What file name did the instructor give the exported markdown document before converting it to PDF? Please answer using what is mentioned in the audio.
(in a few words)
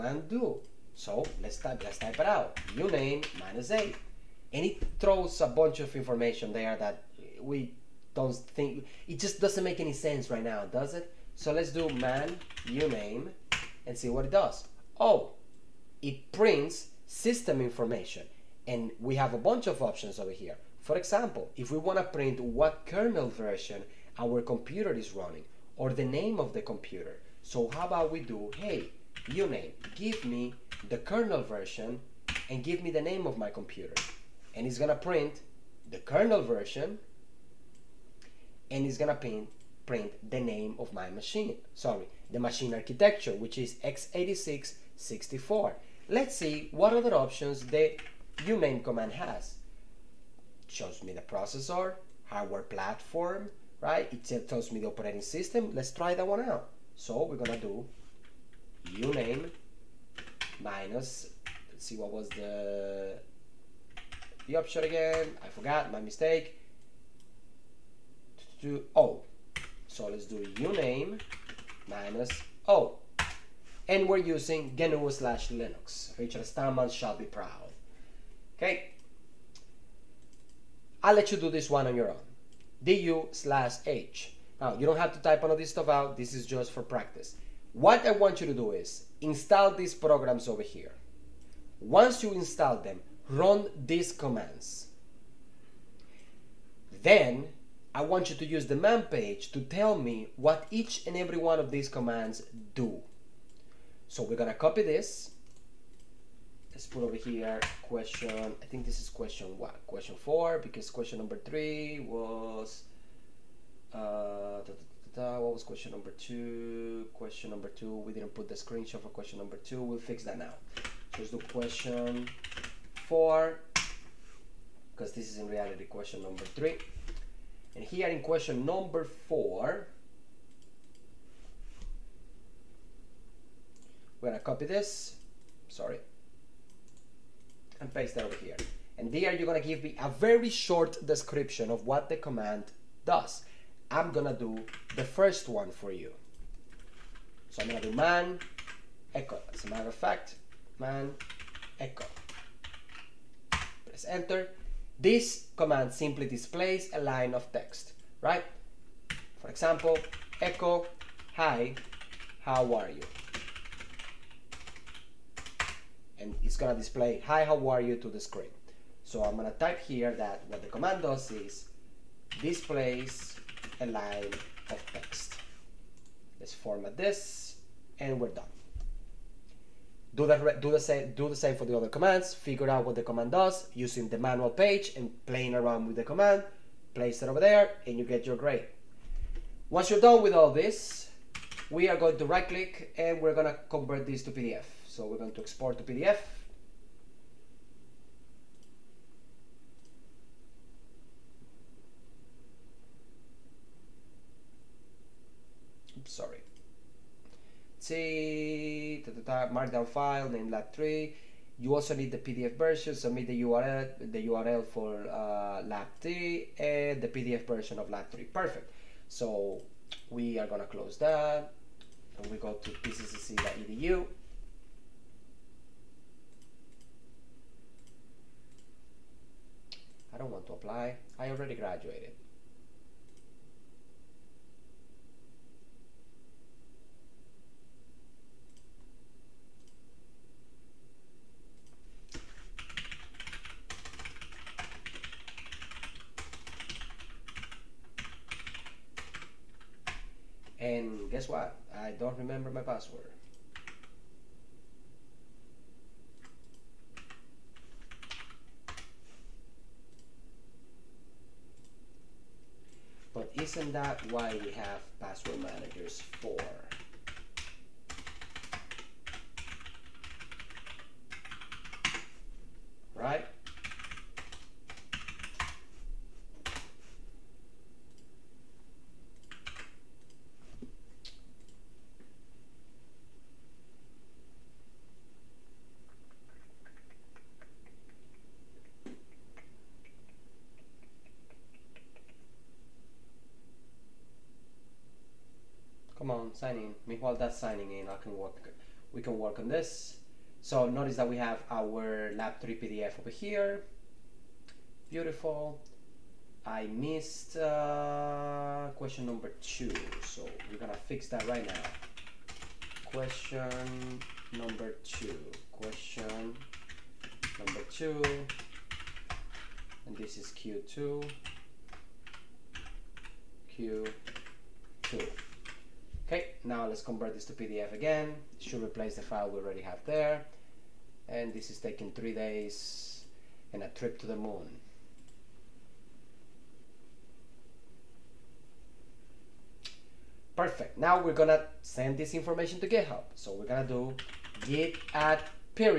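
lab 3.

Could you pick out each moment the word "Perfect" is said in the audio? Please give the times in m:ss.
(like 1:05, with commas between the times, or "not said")
3:38, 5:40.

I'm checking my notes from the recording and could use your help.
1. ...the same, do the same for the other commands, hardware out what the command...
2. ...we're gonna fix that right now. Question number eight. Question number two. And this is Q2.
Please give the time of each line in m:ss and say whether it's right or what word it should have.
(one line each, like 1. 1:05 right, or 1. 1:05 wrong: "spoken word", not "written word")
1. 3:00 wrong: "figure", not "hardware"
2. 5:10 wrong: "two", not "eight".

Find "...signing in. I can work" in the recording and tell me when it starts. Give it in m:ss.
4:57.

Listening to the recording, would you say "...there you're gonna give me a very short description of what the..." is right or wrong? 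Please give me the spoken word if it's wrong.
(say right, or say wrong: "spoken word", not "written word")
right.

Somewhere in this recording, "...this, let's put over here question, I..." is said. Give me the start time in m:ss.
1:44.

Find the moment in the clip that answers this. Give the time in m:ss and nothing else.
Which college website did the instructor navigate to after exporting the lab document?
3:42.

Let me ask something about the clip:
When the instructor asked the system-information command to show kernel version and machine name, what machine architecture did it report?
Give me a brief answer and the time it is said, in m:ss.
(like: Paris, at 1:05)
x86-64, at 0:43.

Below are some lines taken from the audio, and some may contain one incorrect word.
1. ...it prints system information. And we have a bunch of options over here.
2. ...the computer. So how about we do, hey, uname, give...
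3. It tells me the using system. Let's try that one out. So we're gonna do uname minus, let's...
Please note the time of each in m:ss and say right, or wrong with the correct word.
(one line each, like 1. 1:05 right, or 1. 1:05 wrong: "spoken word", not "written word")
1. 0:16 right
2. 0:26 right
3. 0:54 wrong: "operating", not "using".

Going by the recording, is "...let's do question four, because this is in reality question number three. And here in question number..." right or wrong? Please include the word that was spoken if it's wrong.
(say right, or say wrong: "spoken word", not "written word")
right.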